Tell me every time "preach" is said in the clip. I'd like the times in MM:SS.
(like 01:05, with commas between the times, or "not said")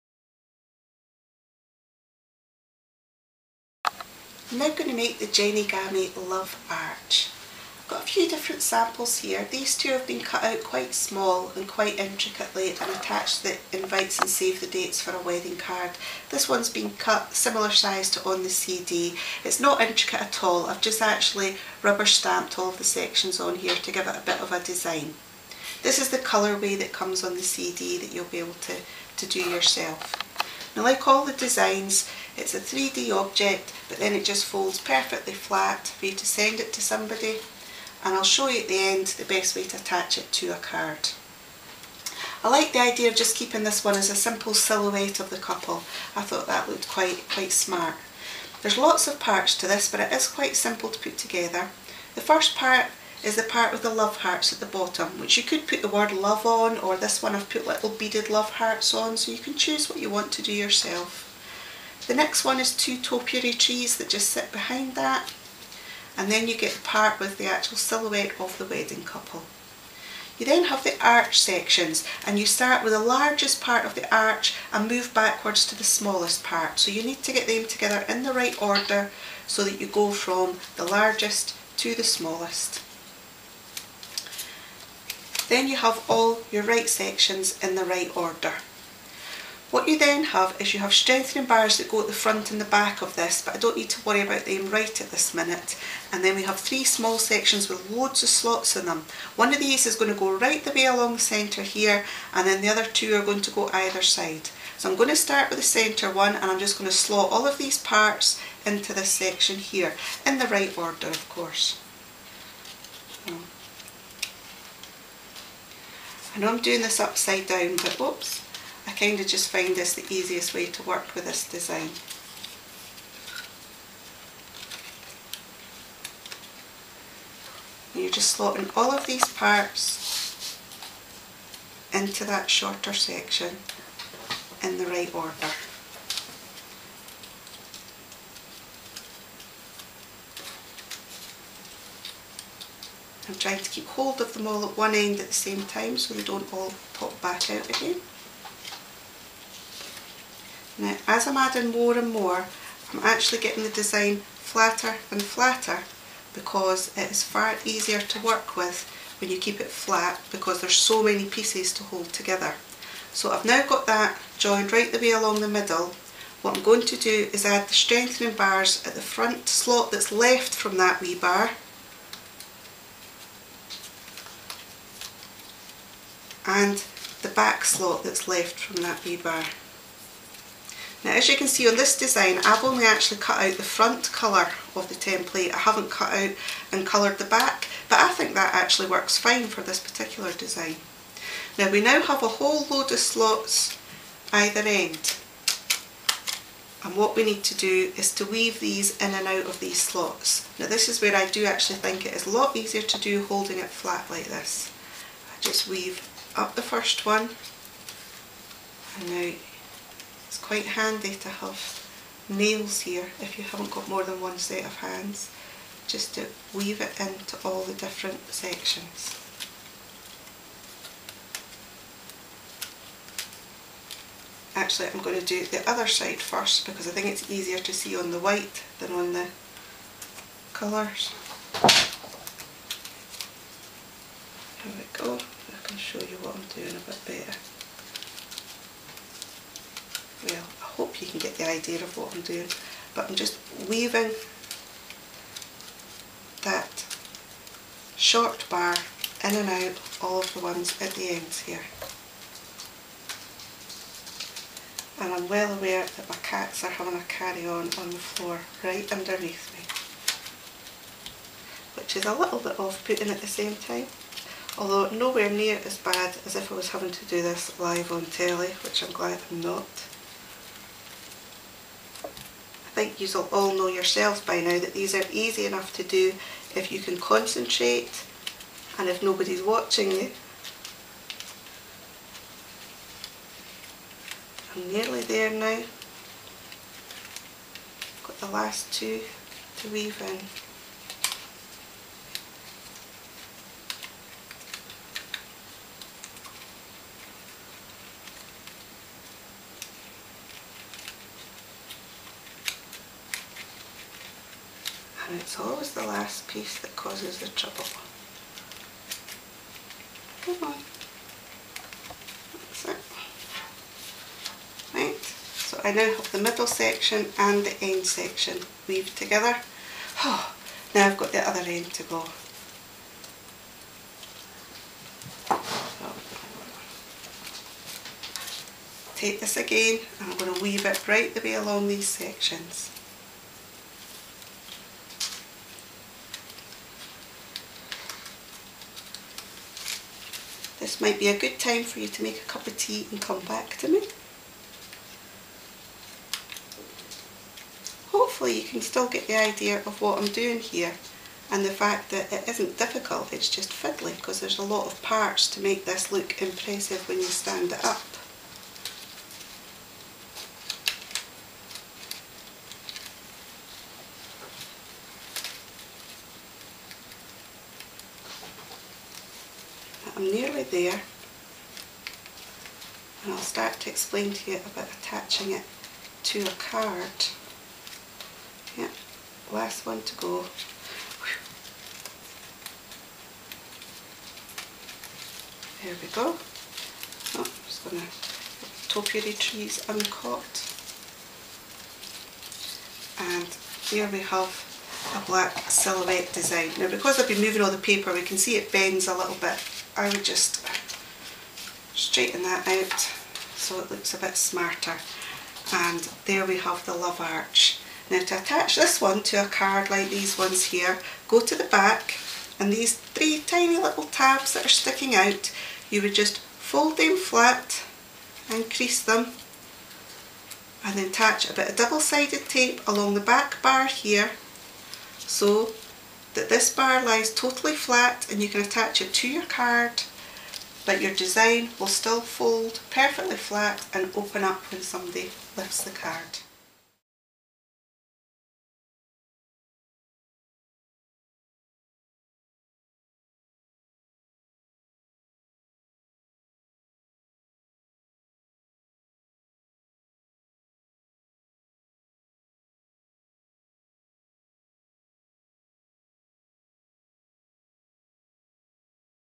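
not said.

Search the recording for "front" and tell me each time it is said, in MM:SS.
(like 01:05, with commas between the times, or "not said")
01:32, 02:49, 03:03.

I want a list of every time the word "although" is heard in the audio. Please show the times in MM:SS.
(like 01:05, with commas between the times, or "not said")
04:24.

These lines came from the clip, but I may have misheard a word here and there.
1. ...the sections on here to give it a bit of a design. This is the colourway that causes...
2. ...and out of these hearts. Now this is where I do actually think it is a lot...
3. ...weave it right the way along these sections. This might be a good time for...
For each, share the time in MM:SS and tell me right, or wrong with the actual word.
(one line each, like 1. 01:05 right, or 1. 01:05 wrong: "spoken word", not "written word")
1. 00:22 wrong: "comes", not "causes"
2. 03:19 wrong: "slots", not "hearts"
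3. 05:30 right.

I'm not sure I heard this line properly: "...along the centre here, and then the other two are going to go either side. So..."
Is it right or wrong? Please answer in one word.
right.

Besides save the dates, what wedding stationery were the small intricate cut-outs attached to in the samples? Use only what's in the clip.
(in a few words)
Invites.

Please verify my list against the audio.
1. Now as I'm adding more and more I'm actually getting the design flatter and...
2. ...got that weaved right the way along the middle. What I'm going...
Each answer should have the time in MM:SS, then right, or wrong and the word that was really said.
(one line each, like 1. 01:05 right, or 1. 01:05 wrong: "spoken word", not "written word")
1. 02:30 right
2. 02:43 wrong: "joined", not "weaved".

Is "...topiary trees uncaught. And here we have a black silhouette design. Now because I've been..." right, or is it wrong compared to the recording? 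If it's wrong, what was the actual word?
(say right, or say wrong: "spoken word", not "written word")
right.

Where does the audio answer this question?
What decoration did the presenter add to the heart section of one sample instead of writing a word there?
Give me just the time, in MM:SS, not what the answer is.
00:57.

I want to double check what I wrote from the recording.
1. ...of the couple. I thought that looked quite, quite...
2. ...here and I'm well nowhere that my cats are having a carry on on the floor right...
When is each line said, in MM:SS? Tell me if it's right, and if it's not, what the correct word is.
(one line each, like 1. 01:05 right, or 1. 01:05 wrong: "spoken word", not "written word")
1. 00:45 right
2. 04:11 wrong: "aware", not "nowhere".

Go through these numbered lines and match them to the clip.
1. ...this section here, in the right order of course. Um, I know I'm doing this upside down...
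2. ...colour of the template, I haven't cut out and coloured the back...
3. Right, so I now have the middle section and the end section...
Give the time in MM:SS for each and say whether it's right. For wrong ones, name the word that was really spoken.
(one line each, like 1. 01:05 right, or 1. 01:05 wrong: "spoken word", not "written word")
1. 01:48 right
2. 03:04 right
3. 05:14 right.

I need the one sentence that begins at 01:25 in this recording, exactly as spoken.
Then you have all your right sections in the right order.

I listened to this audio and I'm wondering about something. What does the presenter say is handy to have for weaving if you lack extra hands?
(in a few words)
Nails.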